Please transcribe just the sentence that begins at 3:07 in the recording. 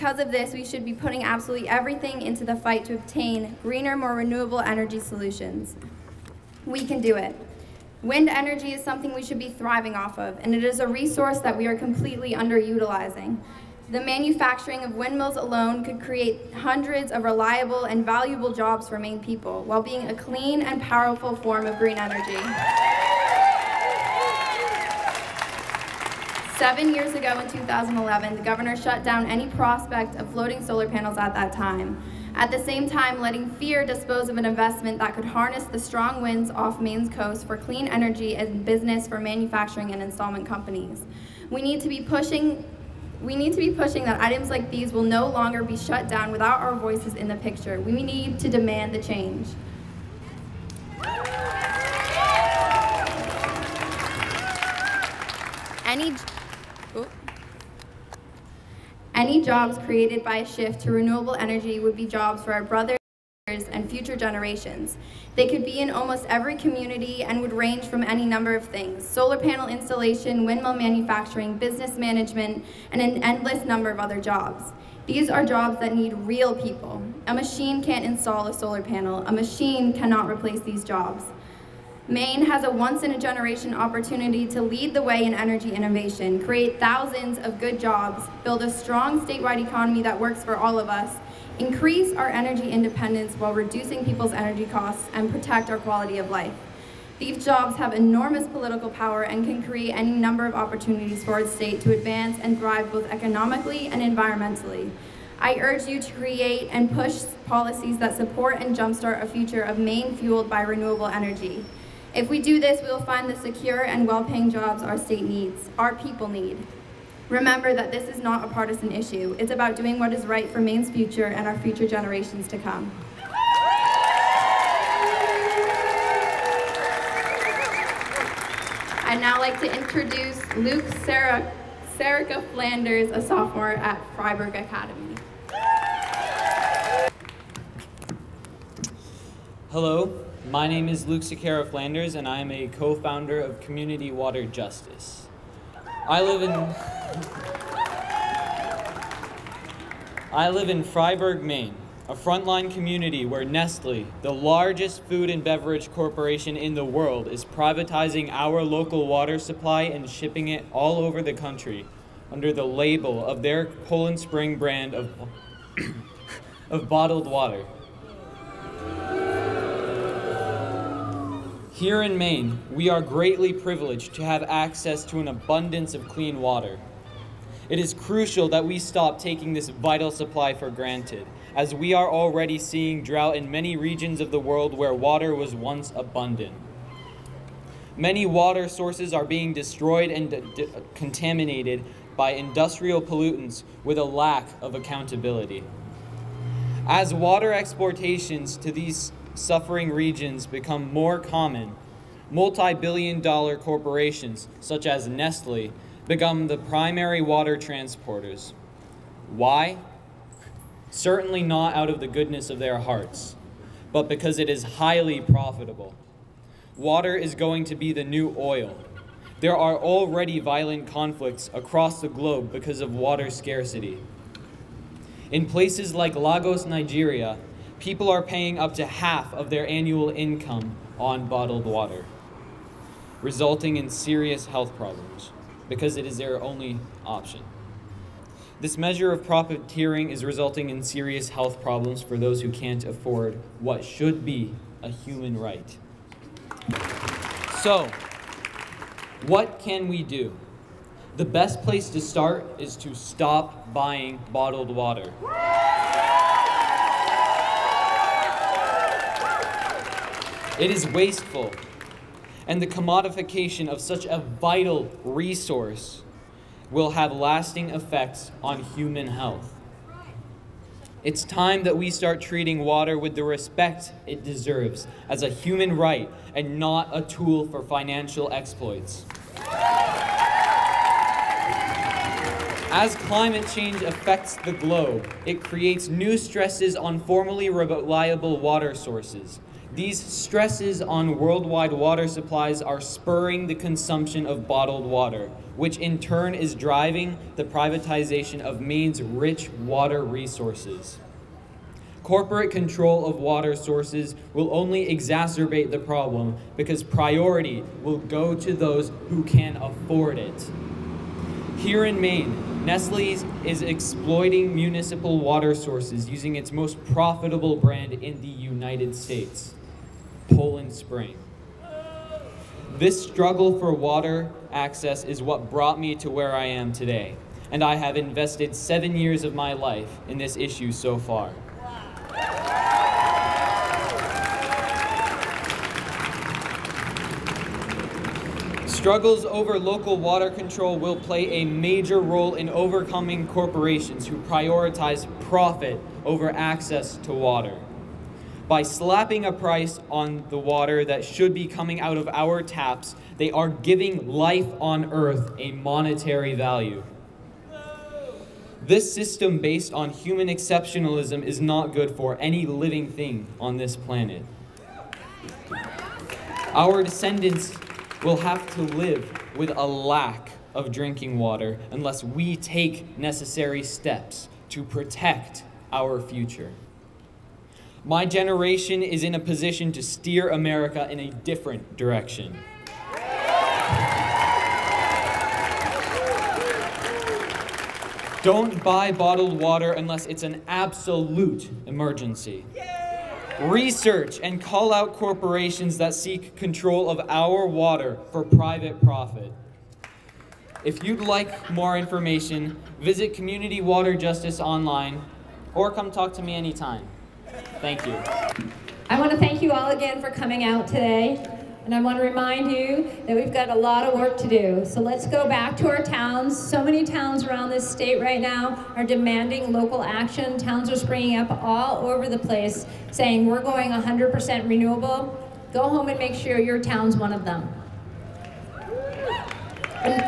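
Many water sources are being destroyed and contaminated by industrial pollutants with a lack of accountability.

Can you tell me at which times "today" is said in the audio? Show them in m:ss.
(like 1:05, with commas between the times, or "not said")
5:26, 6:50.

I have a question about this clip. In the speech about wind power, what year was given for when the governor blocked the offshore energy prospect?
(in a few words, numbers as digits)
2011.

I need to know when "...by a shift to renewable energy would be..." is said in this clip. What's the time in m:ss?
1:00.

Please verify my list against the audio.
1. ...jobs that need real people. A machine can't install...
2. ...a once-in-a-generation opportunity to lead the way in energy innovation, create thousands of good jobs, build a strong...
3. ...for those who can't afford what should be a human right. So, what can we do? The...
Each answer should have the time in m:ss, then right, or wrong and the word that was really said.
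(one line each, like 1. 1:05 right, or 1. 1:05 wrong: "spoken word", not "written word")
1. 1:15 right
2. 1:22 right
3. 4:02 right.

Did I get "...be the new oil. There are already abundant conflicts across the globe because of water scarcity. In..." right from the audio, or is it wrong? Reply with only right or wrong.
wrong.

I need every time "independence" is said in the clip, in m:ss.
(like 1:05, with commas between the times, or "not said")
1:32.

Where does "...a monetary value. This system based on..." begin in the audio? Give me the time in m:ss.
5:55.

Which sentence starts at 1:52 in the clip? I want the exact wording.
If we do this, we will find the secure and well-paying jobs our state needs, our people need.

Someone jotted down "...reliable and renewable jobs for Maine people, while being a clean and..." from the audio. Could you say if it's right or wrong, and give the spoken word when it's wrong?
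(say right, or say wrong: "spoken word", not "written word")
wrong: "valuable", not "renewable".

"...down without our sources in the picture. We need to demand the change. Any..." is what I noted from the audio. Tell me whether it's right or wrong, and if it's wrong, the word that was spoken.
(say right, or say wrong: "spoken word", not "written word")
wrong: "voices", not "sources".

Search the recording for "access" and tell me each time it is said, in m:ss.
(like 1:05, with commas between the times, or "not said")
2:54, 5:24, 5:46.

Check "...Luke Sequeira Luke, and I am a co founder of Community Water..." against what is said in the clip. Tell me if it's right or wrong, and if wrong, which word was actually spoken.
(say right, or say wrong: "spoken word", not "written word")
wrong: "Flanders", not "Luke".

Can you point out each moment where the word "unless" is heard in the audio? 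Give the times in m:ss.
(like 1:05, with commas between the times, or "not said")
6:11, 6:29.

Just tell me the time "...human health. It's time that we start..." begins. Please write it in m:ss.
4:28.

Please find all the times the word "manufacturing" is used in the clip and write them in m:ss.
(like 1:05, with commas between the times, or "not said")
0:13, 0:39, 1:10.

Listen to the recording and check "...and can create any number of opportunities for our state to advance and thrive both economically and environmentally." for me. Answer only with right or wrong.
right.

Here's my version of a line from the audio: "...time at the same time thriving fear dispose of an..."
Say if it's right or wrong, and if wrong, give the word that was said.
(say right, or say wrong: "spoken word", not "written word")
wrong: "letting", not "thriving".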